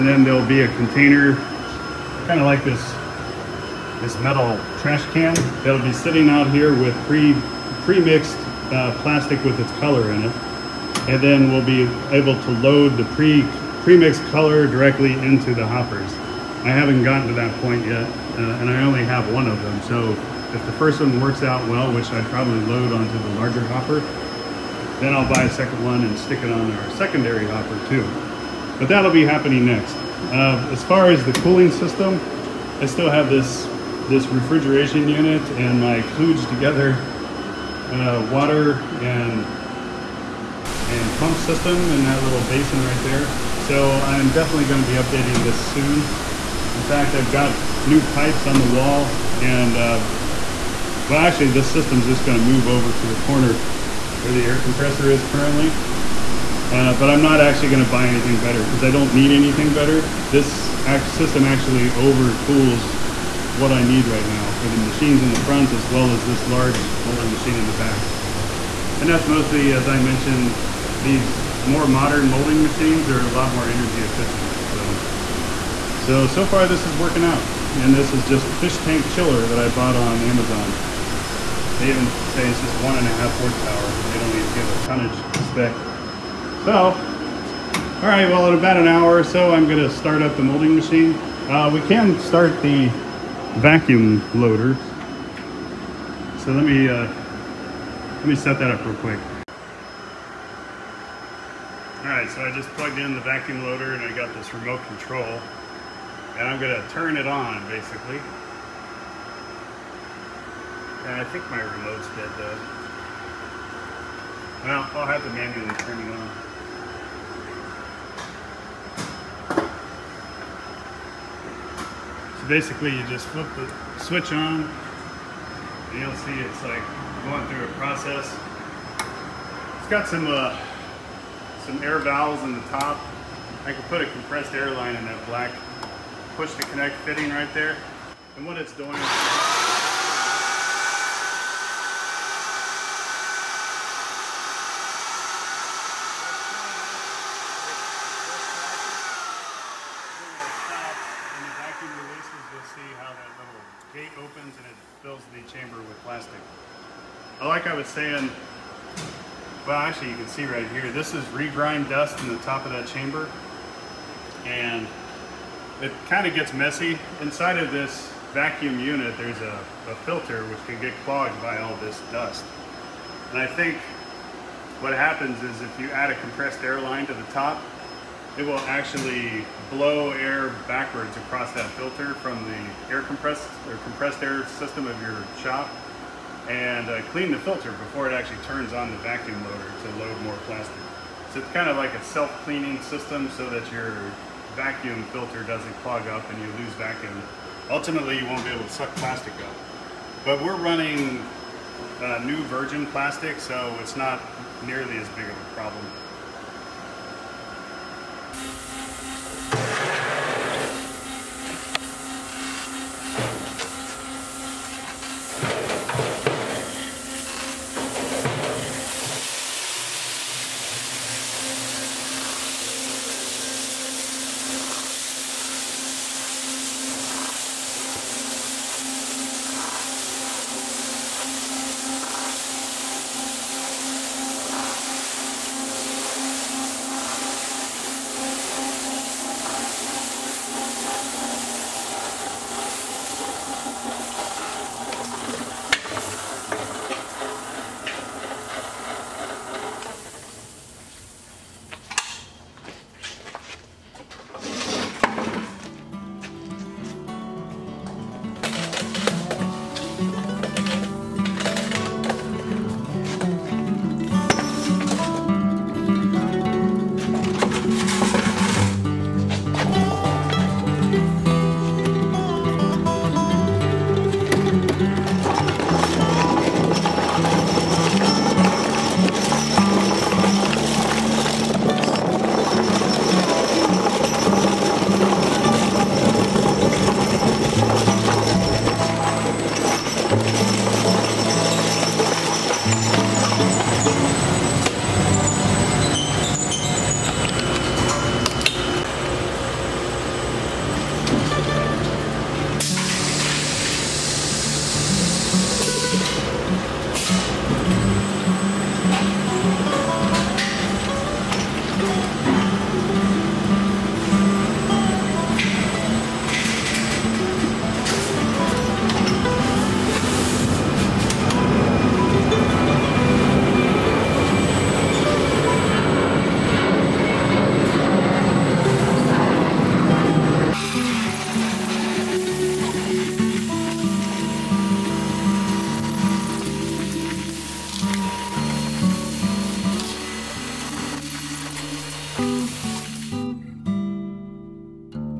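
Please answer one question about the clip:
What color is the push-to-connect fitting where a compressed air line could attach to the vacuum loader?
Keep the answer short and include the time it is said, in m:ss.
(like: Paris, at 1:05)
black, at 2:15.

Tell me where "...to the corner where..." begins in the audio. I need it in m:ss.
0:52.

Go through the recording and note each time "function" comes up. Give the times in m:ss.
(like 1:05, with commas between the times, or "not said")
not said.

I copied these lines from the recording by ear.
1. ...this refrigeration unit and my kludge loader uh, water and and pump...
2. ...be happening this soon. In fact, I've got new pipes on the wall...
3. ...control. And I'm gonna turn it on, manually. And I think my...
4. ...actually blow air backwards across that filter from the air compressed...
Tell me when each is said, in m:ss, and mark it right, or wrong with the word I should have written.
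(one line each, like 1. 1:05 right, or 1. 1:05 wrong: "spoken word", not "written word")
1. 0:34 wrong: "together", not "loader"
2. 0:44 wrong: "updating", not "happening"
3. 1:44 wrong: "basically", not "manually"
4. 2:58 right.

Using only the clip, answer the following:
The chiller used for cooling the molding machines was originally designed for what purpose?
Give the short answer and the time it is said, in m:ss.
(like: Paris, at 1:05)
fish tank, at 1:18.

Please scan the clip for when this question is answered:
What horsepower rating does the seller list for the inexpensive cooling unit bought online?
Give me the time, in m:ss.
1:22.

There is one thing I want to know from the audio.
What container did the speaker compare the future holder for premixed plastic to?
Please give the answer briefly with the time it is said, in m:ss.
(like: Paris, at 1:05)
trash can, at 0:04.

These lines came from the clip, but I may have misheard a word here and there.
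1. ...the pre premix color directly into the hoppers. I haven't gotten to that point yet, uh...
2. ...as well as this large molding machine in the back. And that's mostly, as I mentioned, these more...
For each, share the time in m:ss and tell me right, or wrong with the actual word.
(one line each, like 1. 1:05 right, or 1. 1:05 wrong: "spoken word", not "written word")
1. 0:12 right
2. 1:05 right.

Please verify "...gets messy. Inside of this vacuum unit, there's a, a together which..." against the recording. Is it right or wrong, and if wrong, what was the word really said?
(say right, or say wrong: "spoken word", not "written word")
wrong: "filter", not "together".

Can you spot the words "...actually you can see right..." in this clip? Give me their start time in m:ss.
2:39.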